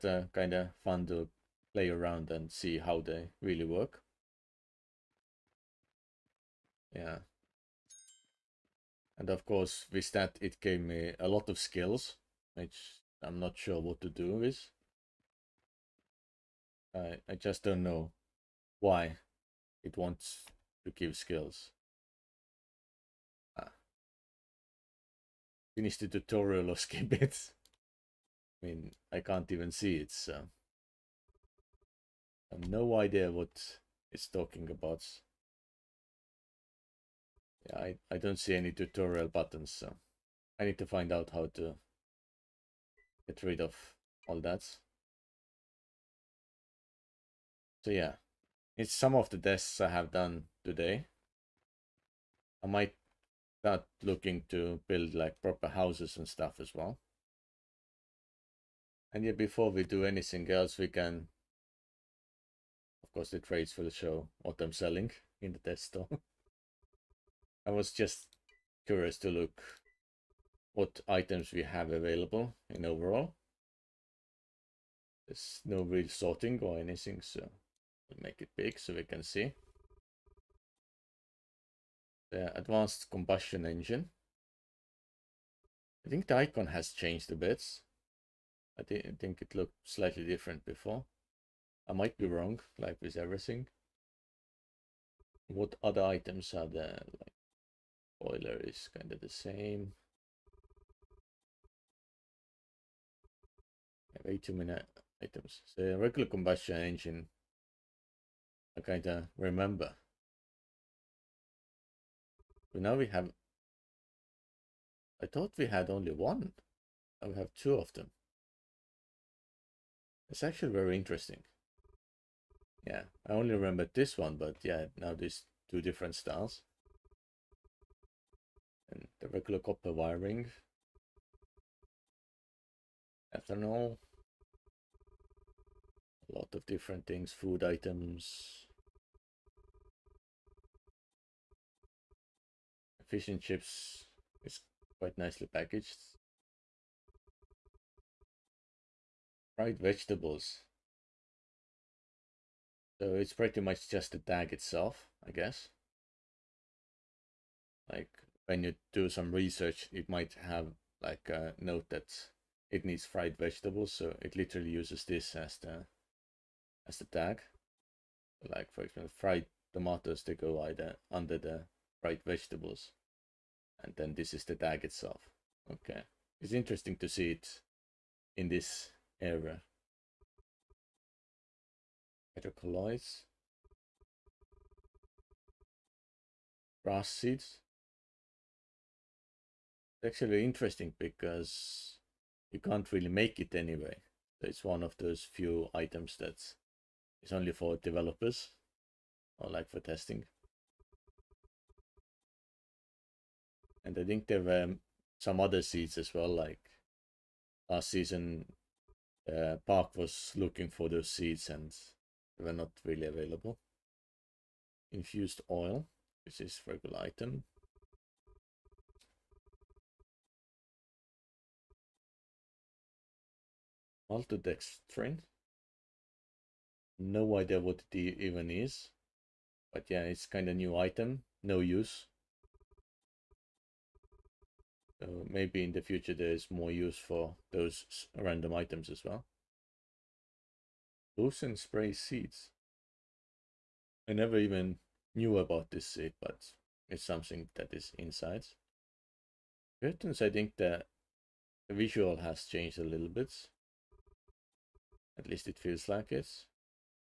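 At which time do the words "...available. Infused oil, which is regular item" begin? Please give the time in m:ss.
3:33.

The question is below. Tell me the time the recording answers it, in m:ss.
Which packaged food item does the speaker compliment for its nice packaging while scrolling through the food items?
2:23.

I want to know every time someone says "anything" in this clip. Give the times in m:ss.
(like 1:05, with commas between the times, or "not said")
1:00, 1:16.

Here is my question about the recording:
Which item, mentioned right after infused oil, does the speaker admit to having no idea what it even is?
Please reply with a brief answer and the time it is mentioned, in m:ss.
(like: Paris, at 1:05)
Maltodextrin, at 3:44.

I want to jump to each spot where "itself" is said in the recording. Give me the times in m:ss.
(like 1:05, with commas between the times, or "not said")
2:34, 2:54.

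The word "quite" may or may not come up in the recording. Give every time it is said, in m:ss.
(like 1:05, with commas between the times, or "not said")
2:24.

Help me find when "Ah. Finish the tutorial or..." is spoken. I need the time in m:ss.
0:23.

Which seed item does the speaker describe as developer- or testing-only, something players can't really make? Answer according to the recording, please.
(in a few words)
Grass seeds.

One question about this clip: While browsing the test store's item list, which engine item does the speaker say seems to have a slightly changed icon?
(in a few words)
Advanced combustion engine.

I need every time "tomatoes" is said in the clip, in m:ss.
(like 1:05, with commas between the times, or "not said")
2:49.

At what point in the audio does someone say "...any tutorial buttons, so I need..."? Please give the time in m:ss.
0:38.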